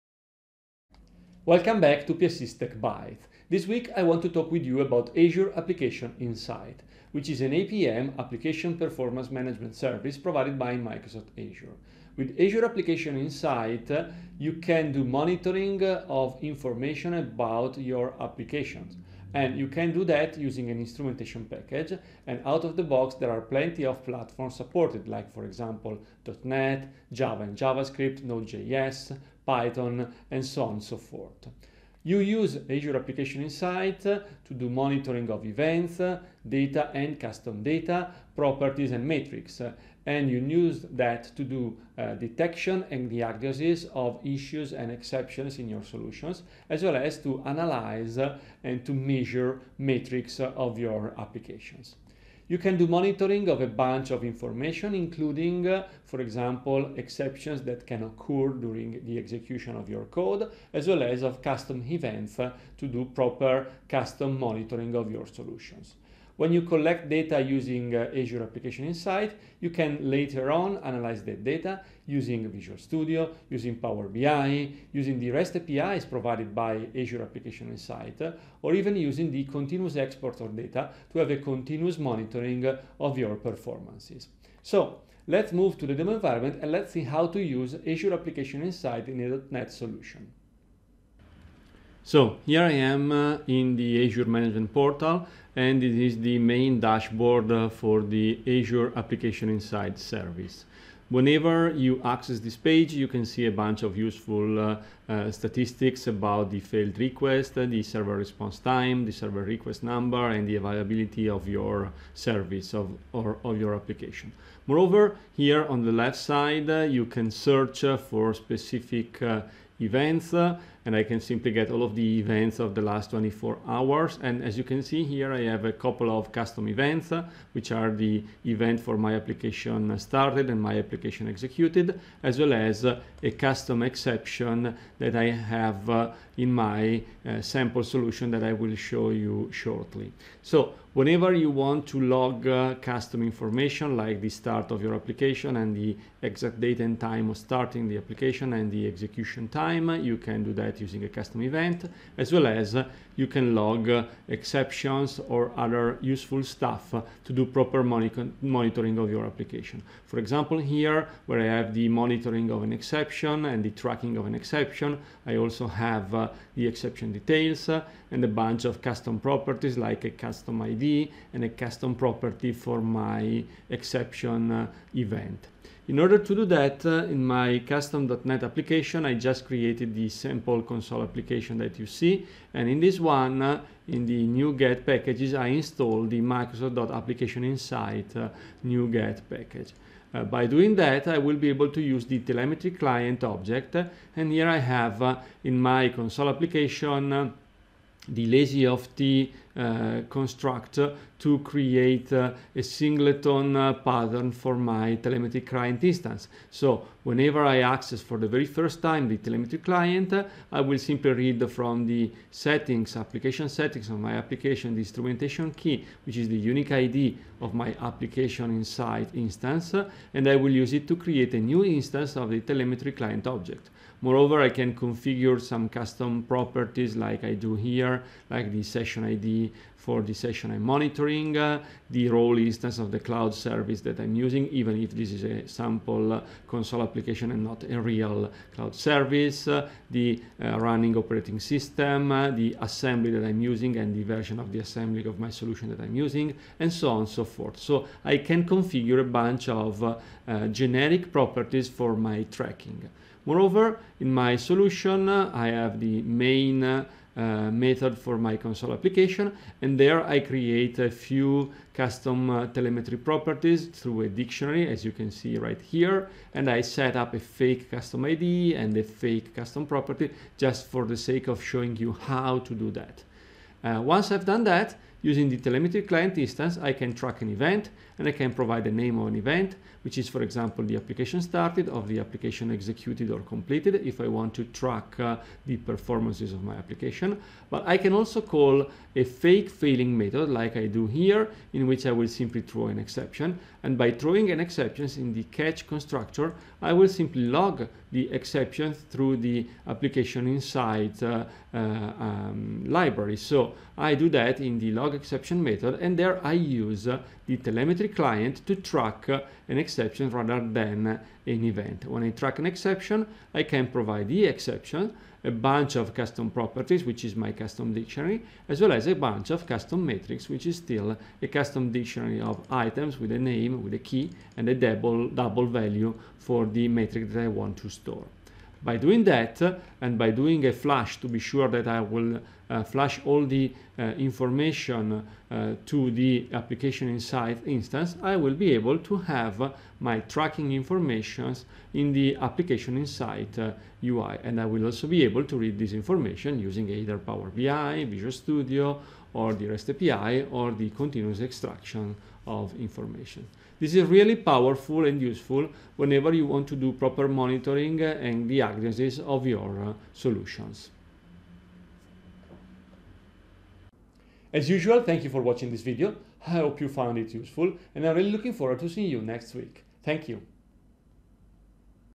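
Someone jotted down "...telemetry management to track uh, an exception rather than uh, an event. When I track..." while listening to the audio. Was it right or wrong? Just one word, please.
wrong.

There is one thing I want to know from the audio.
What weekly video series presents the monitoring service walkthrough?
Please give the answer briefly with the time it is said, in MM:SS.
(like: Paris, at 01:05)
PiaSys Tech Bites, at 00:02.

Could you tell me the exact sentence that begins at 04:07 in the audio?
So I can configure a bunch of generic properties for my tracking.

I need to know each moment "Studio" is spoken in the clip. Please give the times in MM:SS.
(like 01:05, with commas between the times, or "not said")
01:12, 05:48.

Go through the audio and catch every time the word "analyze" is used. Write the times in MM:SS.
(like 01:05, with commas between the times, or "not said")
00:47, 01:10.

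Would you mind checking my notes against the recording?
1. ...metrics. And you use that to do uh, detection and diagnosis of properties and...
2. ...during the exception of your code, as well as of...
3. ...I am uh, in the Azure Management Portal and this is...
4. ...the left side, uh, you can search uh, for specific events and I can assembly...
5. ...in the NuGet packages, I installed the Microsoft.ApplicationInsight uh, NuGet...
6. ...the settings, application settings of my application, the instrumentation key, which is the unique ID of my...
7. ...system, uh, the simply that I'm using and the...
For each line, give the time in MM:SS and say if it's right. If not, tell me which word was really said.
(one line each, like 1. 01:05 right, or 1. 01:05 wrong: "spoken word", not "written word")
1. 00:39 wrong: "issues", not "properties"
2. 00:58 wrong: "execution", not "exception"
3. 01:32 right
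4. 01:55 wrong: "simply", not "assembly"
5. 03:03 right
6. 03:31 right
7. 04:01 wrong: "assembly", not "simply".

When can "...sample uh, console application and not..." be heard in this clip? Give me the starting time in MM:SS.
03:55.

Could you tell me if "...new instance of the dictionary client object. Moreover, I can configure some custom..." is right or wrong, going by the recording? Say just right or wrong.
wrong.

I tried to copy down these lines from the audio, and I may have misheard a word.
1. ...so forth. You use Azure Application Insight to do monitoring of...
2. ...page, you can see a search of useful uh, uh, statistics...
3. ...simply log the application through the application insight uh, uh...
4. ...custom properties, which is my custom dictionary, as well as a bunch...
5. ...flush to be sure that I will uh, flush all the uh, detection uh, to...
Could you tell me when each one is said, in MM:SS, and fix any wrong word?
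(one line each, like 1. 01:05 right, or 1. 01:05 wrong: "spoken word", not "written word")
1. 00:30 right
2. 01:42 wrong: "bunch", not "search"
3. 04:56 wrong: "exception", not "application"
4. 05:15 right
5. 05:30 wrong: "information", not "detection".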